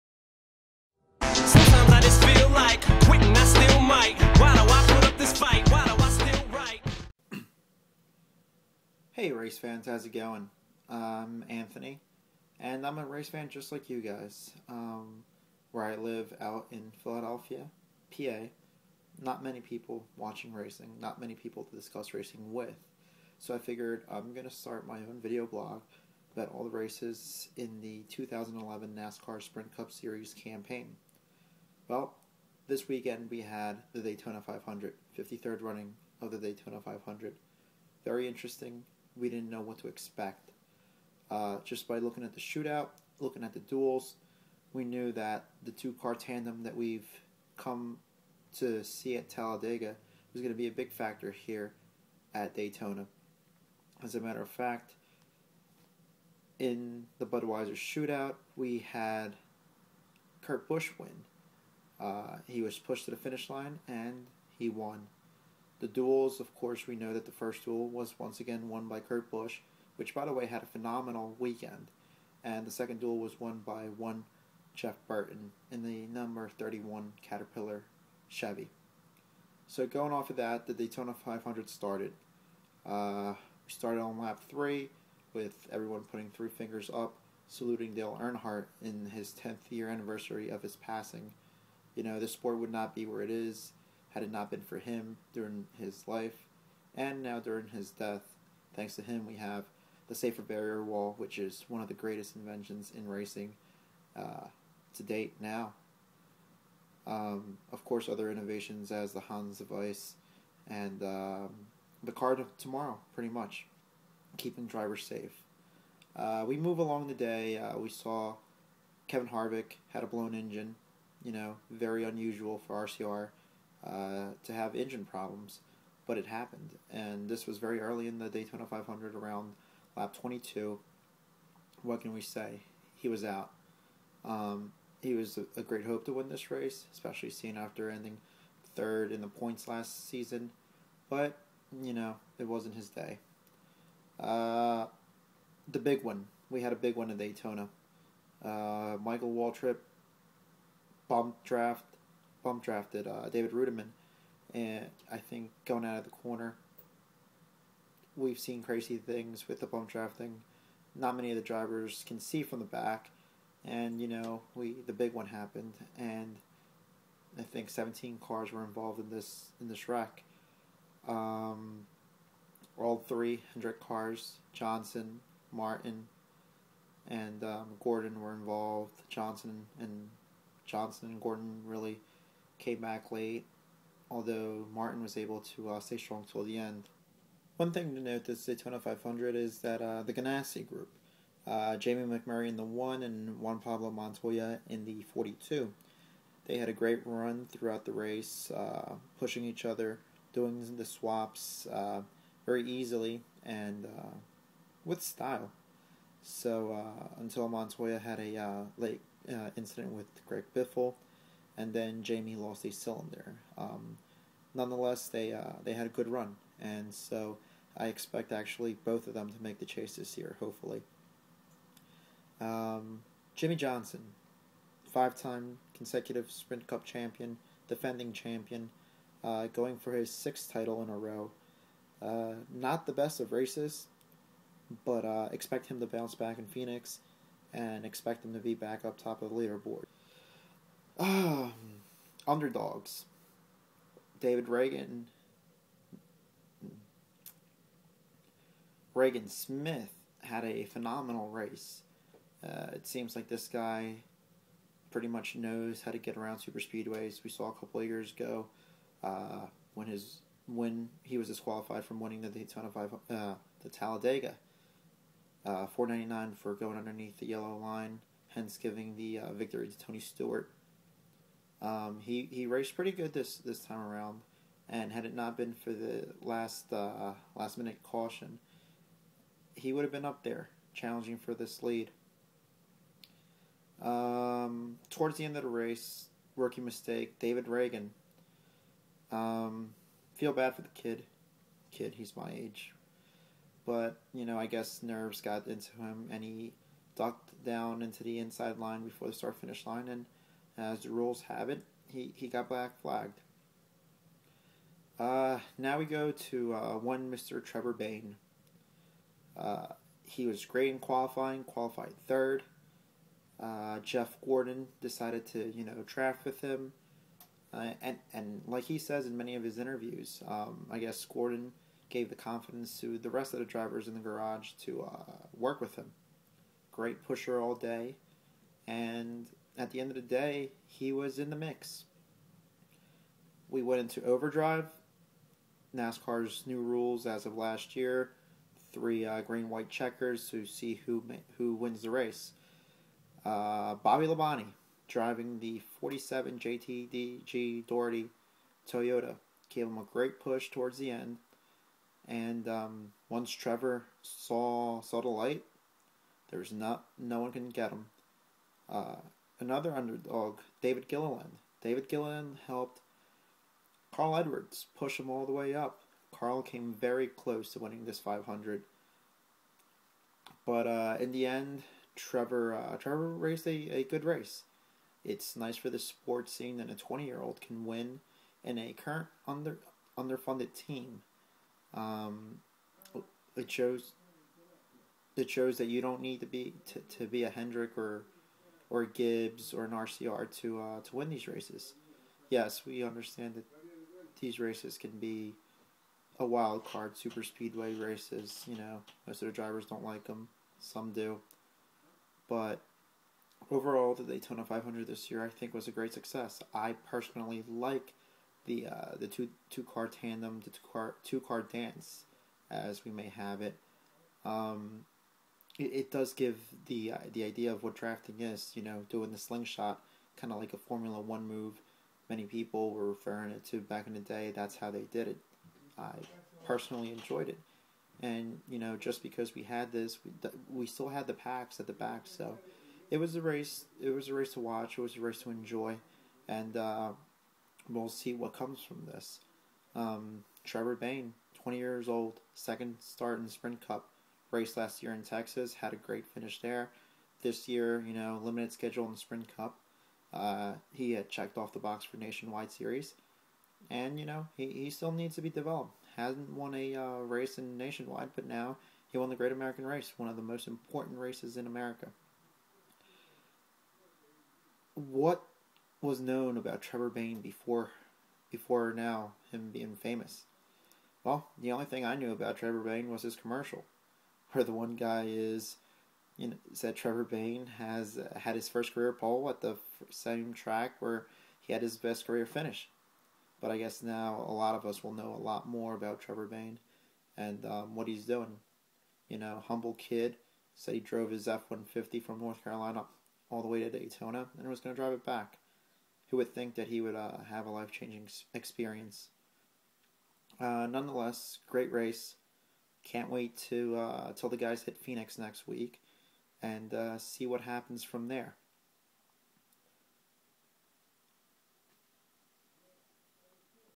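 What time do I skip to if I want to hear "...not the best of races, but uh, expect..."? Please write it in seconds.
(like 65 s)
232 s.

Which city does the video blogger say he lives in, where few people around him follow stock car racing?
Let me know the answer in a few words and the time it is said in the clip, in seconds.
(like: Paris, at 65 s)
Philadelphia, at 17 s.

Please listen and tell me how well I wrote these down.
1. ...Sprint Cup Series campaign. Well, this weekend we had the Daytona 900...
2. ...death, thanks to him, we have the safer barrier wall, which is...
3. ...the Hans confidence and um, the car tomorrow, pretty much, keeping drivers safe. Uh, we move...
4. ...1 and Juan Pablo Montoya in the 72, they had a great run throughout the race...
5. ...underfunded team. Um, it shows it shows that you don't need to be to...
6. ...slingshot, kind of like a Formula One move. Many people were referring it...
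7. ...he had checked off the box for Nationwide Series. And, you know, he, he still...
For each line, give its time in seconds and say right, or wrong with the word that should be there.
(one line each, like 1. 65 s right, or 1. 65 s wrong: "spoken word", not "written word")
1. 29 s wrong: "500", not "900"
2. 97 s right
3. 109 s wrong: "device", not "confidence"
4. 192 s wrong: "42", not "72"
5. 379 s right
6. 419 s right
7. 450 s right.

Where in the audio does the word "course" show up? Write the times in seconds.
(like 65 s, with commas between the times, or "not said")
66 s, 107 s.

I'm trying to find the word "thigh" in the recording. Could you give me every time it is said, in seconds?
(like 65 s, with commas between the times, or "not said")
not said.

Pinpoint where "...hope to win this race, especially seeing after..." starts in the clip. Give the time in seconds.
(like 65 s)
135 s.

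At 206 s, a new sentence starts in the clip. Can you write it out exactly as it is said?
So until Montoya had a late incident with Greg Biffle, and then Jamie lost a cylinder.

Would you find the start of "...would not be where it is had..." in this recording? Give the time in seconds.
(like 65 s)
92 s.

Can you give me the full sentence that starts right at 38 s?
Very interesting, we didn't know what to expect.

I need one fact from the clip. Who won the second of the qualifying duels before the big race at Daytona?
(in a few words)
Jeff Burton.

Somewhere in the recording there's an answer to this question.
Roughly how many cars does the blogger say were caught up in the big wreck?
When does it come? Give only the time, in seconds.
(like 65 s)
167 s.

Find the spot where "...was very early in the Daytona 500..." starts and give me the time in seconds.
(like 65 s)
127 s.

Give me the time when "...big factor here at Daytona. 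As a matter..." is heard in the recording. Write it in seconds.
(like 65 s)
50 s.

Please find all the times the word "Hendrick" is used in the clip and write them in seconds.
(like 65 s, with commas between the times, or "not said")
173 s, 387 s.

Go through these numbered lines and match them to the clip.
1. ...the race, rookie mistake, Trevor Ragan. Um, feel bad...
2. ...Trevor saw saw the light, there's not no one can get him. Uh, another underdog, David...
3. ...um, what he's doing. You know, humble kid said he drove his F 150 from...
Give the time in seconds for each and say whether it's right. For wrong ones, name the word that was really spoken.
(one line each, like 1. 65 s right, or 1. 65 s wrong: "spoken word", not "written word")
1. 285 s wrong: "David", not "Trevor"
2. 353 s right
3. 487 s right.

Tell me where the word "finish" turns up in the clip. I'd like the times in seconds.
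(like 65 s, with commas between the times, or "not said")
63 s, 299 s, 446 s, 482 s.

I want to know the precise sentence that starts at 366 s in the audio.
Carl came very close to winning this 500.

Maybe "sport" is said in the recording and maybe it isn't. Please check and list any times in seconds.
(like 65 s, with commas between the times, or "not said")
92 s, 375 s.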